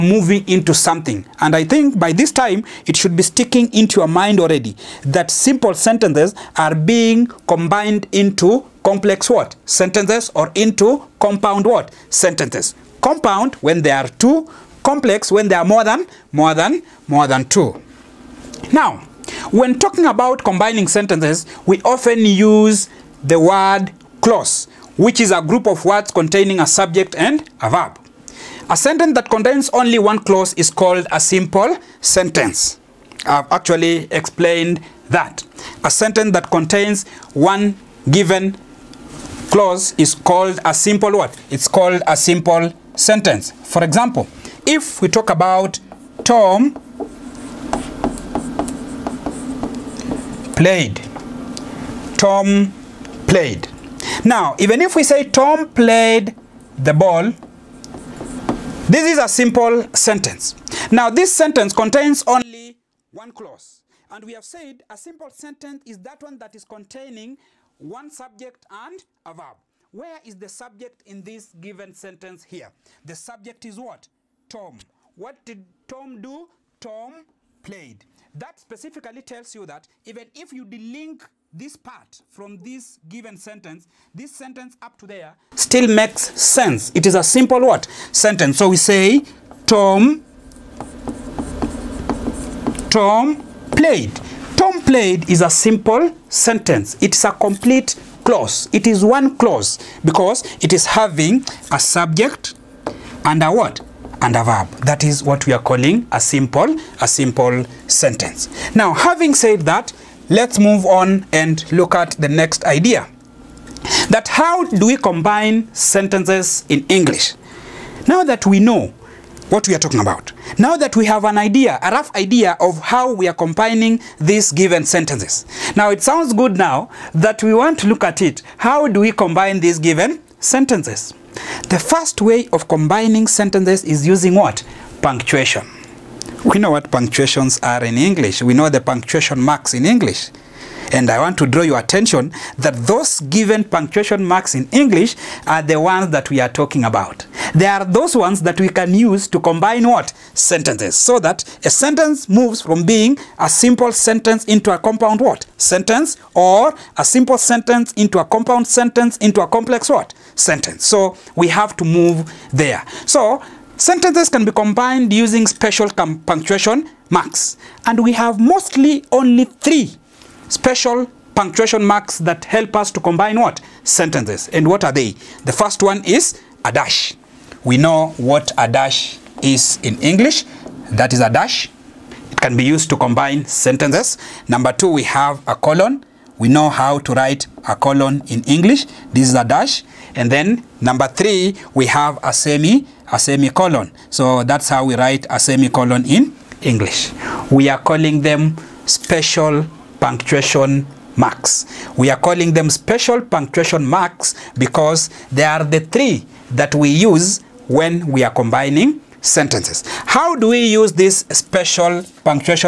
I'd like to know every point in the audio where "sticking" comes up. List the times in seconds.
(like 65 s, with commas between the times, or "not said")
3 s.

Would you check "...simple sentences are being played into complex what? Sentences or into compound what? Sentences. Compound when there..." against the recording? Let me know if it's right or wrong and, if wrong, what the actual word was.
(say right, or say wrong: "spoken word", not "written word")
wrong: "combined", not "played".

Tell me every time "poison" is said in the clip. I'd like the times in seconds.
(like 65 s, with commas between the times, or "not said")
not said.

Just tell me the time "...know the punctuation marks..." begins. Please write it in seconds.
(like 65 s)
138 s.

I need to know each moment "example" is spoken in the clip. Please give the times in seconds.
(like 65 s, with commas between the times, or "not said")
43 s.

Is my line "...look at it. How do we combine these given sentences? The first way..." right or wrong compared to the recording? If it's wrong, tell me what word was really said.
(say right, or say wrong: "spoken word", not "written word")
right.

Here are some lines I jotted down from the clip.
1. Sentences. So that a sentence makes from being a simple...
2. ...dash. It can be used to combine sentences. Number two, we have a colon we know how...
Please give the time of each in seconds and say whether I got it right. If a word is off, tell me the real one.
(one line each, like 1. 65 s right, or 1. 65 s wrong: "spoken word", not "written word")
1. 150 s wrong: "moves", not "makes"
2. 181 s right.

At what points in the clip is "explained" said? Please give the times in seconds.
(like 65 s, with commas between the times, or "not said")
34 s.